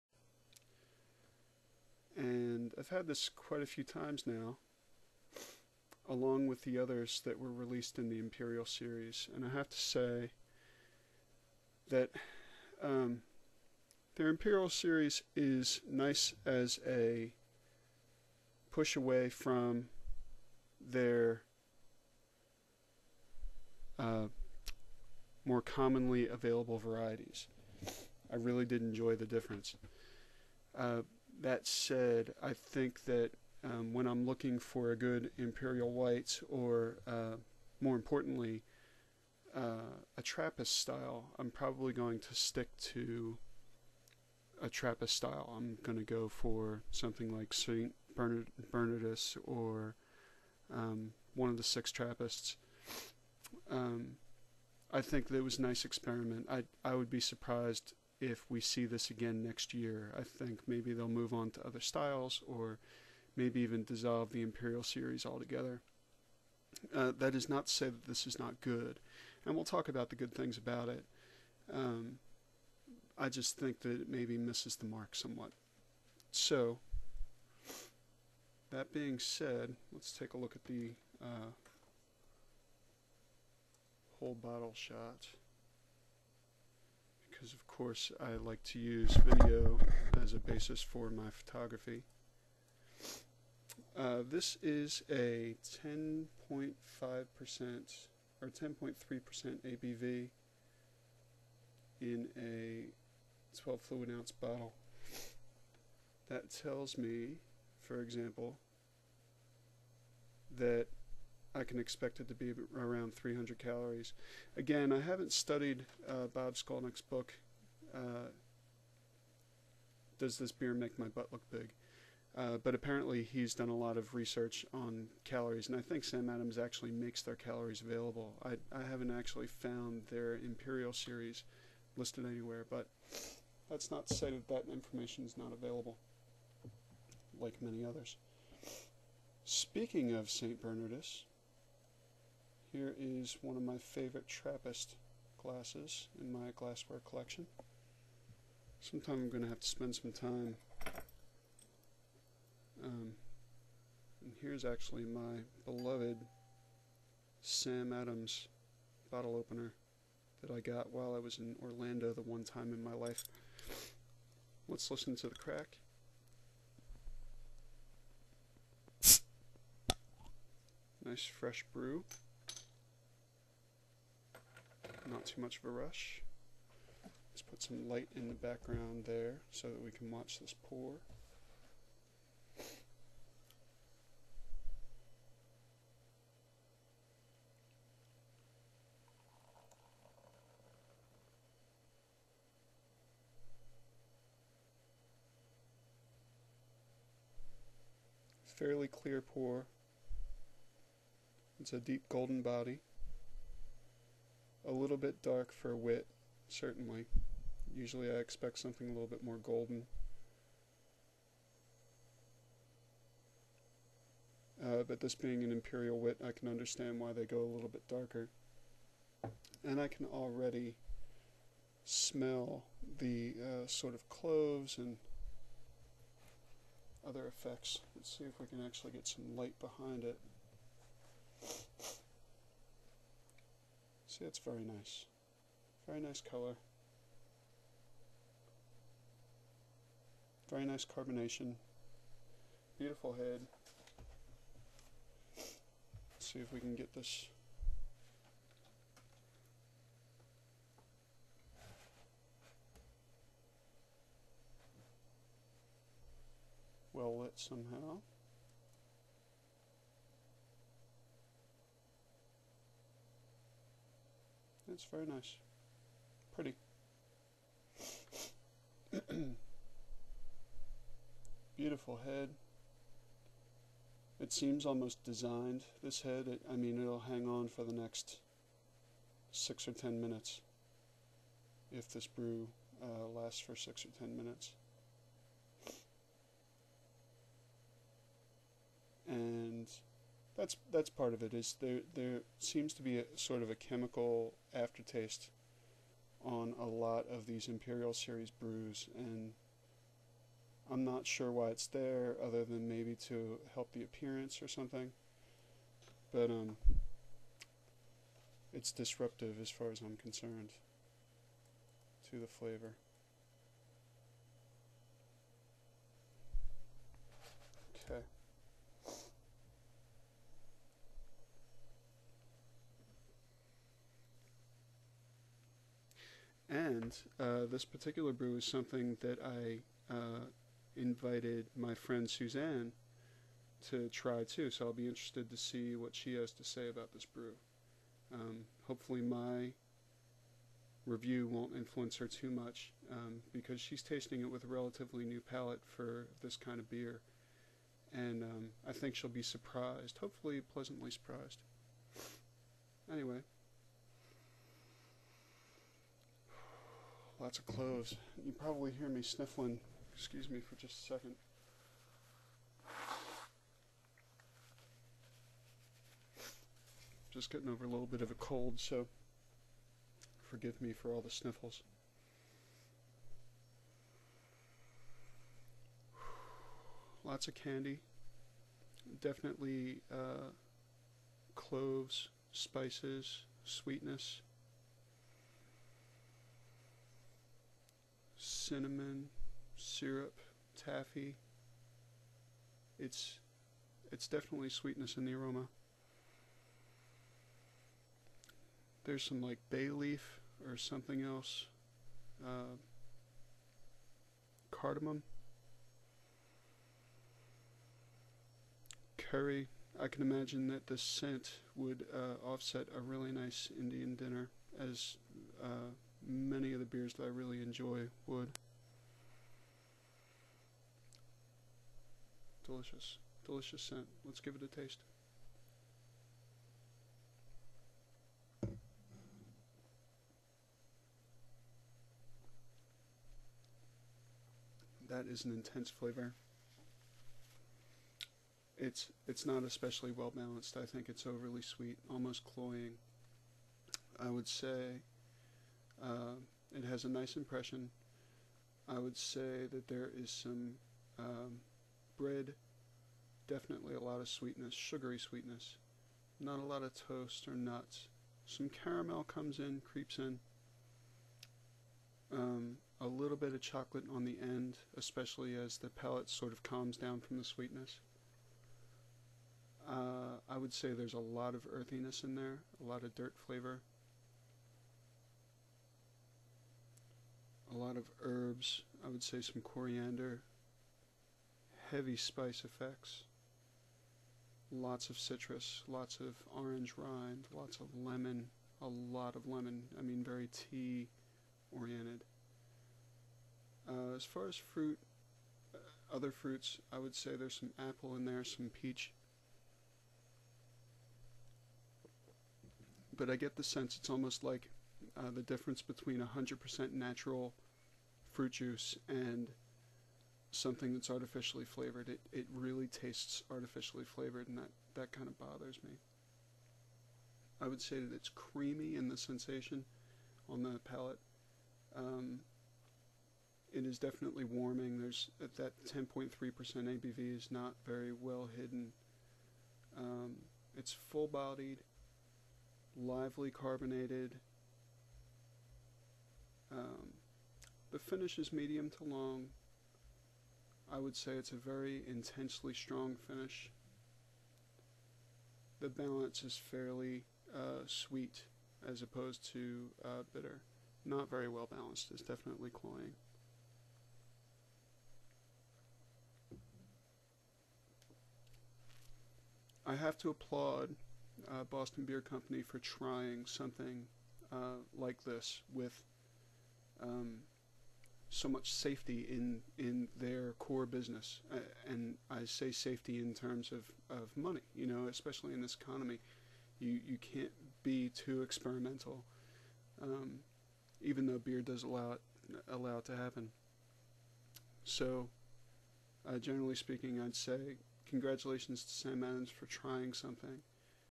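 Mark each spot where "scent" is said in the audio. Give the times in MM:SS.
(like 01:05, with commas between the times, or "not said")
06:50, 07:03.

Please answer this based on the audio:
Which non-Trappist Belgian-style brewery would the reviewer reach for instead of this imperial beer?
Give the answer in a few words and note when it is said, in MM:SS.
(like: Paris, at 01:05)
St. Bernard Bernardus, at 00:47.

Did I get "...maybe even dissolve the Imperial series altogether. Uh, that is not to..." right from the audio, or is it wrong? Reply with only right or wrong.
right.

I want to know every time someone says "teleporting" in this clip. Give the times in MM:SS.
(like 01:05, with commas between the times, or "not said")
not said.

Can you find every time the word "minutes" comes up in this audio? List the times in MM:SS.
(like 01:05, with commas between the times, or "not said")
04:39, 04:44.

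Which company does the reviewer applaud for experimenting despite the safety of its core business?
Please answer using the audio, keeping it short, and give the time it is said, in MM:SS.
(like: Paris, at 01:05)
Boston Beer Company, at 09:21.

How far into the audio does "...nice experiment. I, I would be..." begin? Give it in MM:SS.
00:55.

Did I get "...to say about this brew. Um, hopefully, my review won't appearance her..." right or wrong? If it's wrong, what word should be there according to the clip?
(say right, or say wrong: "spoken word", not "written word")
wrong: "influence", not "appearance".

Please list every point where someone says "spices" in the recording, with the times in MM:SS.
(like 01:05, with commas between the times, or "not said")
06:22, 08:01.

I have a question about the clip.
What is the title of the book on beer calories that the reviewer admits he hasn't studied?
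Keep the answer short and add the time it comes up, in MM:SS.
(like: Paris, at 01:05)
Does This Beer Make My Butt Look Big?, at 02:00.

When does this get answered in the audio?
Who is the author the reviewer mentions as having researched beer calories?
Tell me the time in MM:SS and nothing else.
01:56.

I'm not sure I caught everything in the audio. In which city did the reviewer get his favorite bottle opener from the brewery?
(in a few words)
Orlando.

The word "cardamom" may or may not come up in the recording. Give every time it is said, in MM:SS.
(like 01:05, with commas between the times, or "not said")
06:44.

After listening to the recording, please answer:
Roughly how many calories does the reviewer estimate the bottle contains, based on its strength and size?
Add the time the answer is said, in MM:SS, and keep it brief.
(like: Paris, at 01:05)
300, at 01:53.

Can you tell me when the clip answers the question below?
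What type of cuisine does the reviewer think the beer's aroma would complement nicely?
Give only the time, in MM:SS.
06:53.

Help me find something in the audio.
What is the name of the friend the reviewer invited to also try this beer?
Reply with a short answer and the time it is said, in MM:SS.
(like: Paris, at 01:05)
Suzanne, at 05:32.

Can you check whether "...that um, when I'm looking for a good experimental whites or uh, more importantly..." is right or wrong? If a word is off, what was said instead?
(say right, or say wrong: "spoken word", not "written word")
wrong: "imperial", not "experimental".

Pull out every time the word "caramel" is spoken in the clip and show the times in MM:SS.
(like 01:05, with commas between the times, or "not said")
07:38.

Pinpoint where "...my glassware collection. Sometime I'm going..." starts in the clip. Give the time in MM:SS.
02:26.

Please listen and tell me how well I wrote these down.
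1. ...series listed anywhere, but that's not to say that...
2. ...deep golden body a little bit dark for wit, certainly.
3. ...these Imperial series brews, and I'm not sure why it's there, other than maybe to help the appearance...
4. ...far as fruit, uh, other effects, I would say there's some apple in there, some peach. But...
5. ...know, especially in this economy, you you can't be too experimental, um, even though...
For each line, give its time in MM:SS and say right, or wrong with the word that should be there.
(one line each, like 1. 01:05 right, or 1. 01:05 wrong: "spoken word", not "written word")
1. 02:10 right
2. 03:21 right
3. 04:57 right
4. 08:14 wrong: "fruits", not "effects"
5. 09:34 right.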